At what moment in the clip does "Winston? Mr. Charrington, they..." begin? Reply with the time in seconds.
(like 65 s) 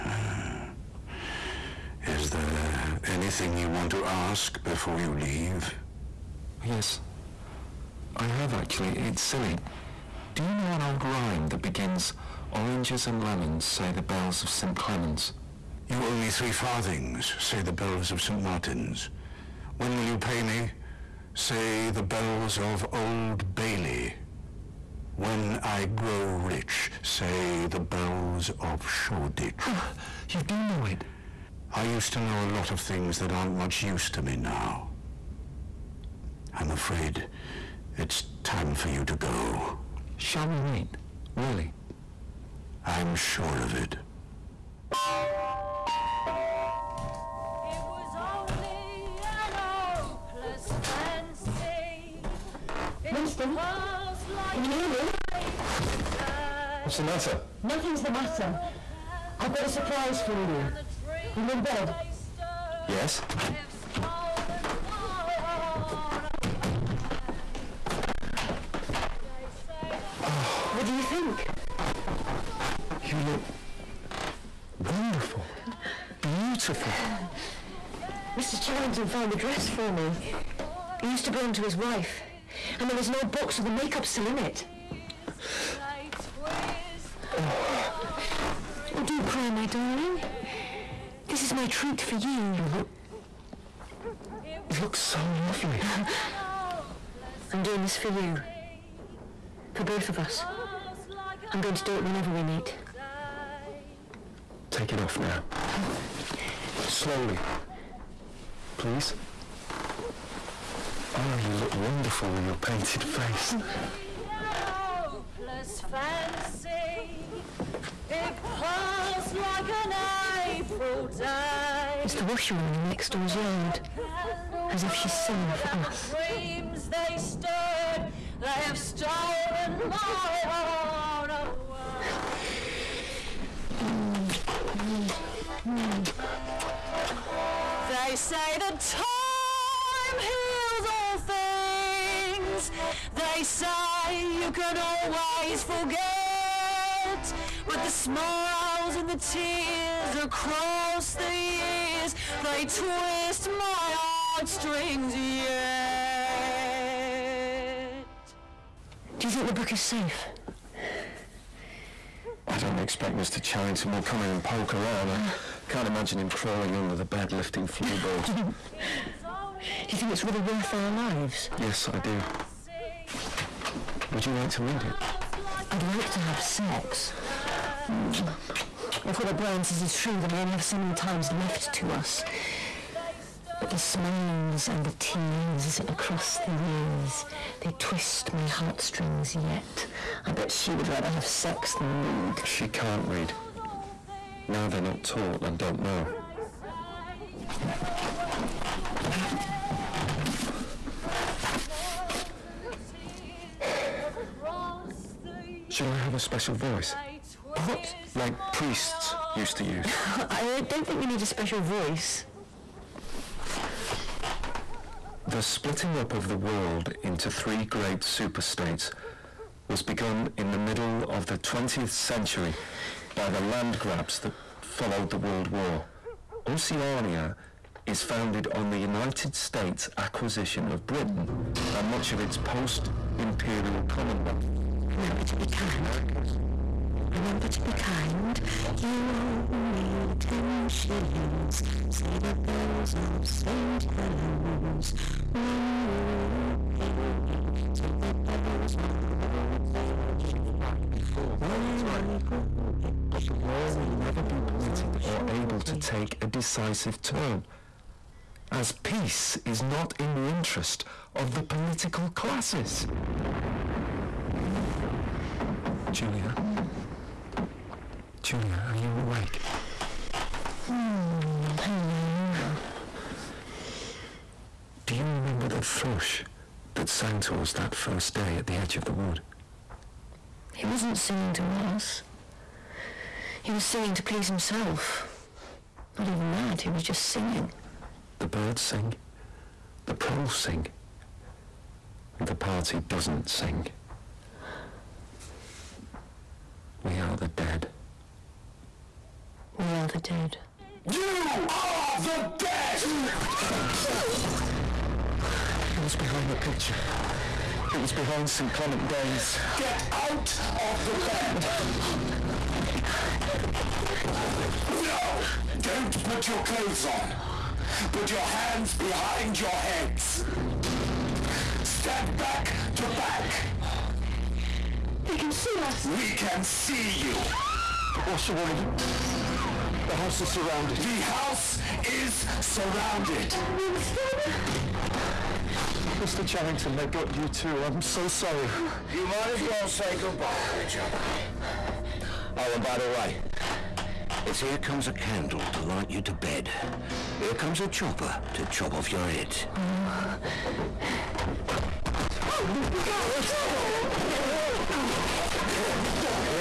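333 s.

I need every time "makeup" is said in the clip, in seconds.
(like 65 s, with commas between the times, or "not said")
83 s.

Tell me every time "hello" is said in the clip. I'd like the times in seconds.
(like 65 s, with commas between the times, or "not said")
271 s.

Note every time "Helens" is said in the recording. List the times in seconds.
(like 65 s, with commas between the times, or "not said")
243 s.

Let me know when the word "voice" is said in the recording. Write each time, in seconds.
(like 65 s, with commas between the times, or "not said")
206 s, 211 s.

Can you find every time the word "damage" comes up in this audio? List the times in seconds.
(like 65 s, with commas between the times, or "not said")
not said.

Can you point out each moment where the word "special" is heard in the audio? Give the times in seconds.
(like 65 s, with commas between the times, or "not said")
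206 s, 211 s.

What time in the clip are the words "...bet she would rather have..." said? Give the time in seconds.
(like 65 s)
190 s.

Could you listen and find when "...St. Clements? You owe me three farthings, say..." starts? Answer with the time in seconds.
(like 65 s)
14 s.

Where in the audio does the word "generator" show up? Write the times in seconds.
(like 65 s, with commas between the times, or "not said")
not said.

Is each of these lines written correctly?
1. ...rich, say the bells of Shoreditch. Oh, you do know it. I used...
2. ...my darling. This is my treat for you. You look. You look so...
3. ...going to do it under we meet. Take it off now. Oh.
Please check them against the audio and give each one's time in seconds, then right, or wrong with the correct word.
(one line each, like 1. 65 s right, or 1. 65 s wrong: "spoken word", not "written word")
1. 26 s right
2. 89 s right
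3. 101 s wrong: "whenever", not "under".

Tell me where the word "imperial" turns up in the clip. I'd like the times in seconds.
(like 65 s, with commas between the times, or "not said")
233 s.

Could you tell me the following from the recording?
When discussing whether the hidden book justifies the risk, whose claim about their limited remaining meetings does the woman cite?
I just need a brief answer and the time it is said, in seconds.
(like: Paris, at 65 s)
O'Brien, at 179 s.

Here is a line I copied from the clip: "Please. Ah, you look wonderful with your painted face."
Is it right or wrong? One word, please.
right.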